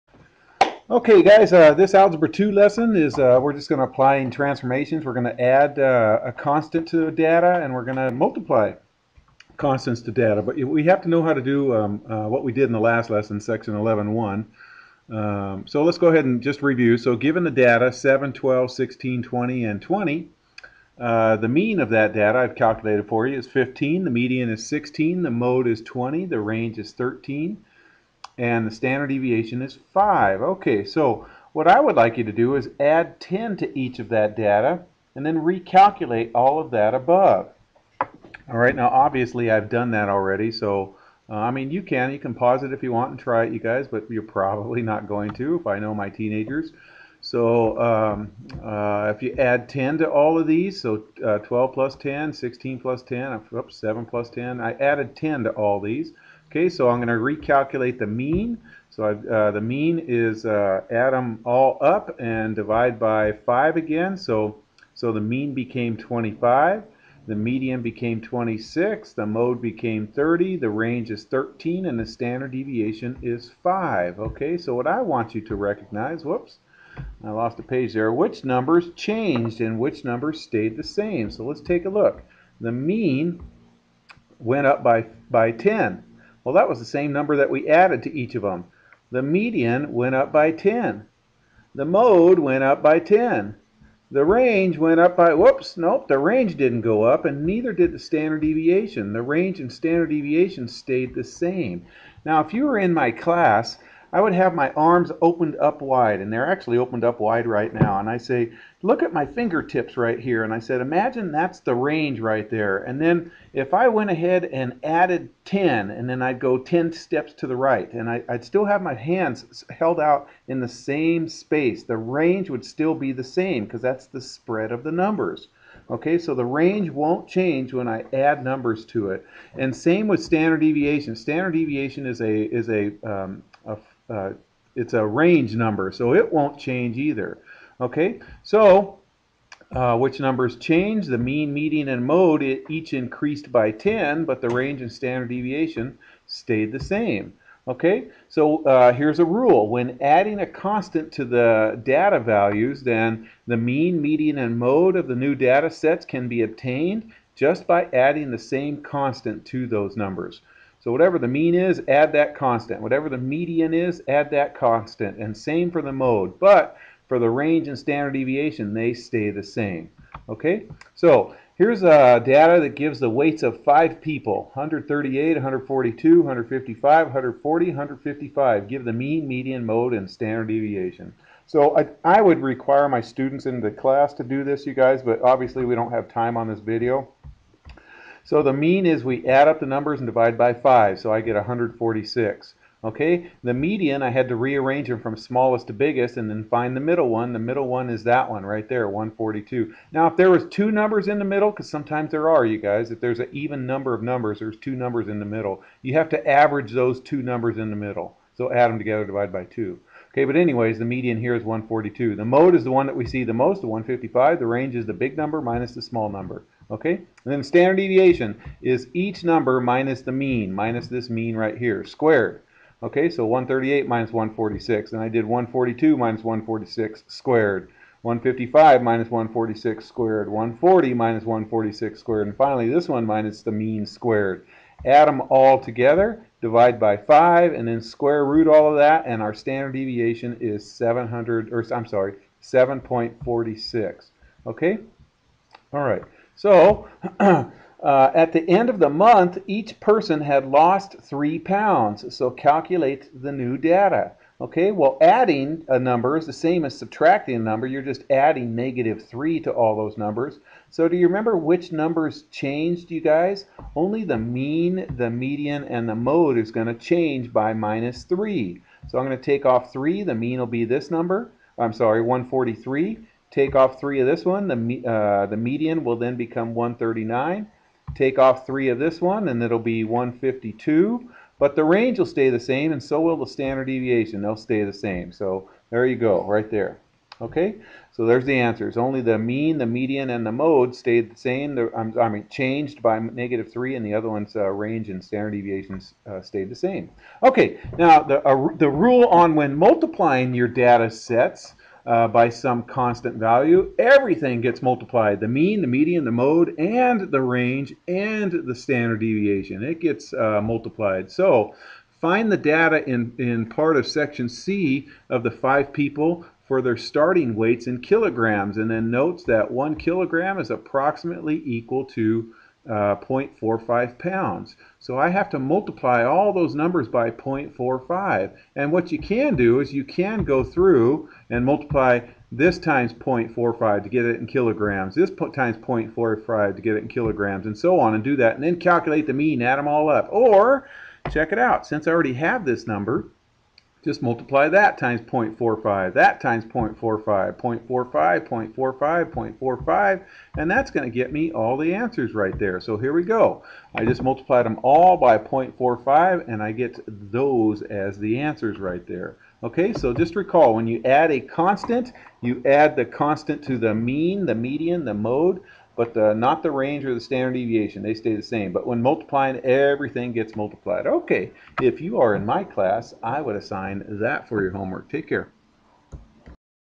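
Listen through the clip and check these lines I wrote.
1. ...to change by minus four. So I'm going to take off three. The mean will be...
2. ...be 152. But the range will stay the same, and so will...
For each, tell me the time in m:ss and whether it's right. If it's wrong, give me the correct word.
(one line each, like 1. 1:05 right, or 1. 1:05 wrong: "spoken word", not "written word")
1. 4:26 wrong: "three", not "four"
2. 4:39 right.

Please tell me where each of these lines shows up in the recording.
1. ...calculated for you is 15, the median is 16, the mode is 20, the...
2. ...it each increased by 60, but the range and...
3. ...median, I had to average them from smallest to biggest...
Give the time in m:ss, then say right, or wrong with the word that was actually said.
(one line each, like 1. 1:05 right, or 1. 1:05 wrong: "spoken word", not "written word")
1. 0:22 right
2. 2:22 wrong: "10", not "60"
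3. 3:13 wrong: "rearrange", not "average".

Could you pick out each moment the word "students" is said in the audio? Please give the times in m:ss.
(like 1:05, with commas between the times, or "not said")
3:03.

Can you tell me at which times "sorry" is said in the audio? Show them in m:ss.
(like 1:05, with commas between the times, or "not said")
4:01, 4:31.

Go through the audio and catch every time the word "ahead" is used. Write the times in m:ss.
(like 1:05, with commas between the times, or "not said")
0:16, 1:54.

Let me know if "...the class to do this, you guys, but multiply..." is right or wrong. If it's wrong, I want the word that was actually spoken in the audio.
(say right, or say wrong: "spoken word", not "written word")
wrong: "obviously", not "multiply".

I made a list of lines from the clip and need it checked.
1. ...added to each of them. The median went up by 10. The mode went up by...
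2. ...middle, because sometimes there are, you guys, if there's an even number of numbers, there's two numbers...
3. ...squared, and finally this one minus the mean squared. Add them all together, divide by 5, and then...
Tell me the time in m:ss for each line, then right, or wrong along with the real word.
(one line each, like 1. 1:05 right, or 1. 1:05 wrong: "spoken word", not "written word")
1. 1:27 right
2. 3:21 right
3. 3:51 right.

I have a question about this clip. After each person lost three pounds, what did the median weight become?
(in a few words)
139.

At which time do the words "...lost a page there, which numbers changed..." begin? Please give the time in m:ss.
1:17.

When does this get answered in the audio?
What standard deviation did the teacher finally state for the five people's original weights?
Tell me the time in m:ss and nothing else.
4:02.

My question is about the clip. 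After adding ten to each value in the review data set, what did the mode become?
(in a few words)
30.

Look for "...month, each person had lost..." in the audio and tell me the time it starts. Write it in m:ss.
4:08.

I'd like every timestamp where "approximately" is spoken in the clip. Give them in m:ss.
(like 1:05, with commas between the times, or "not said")
5:20.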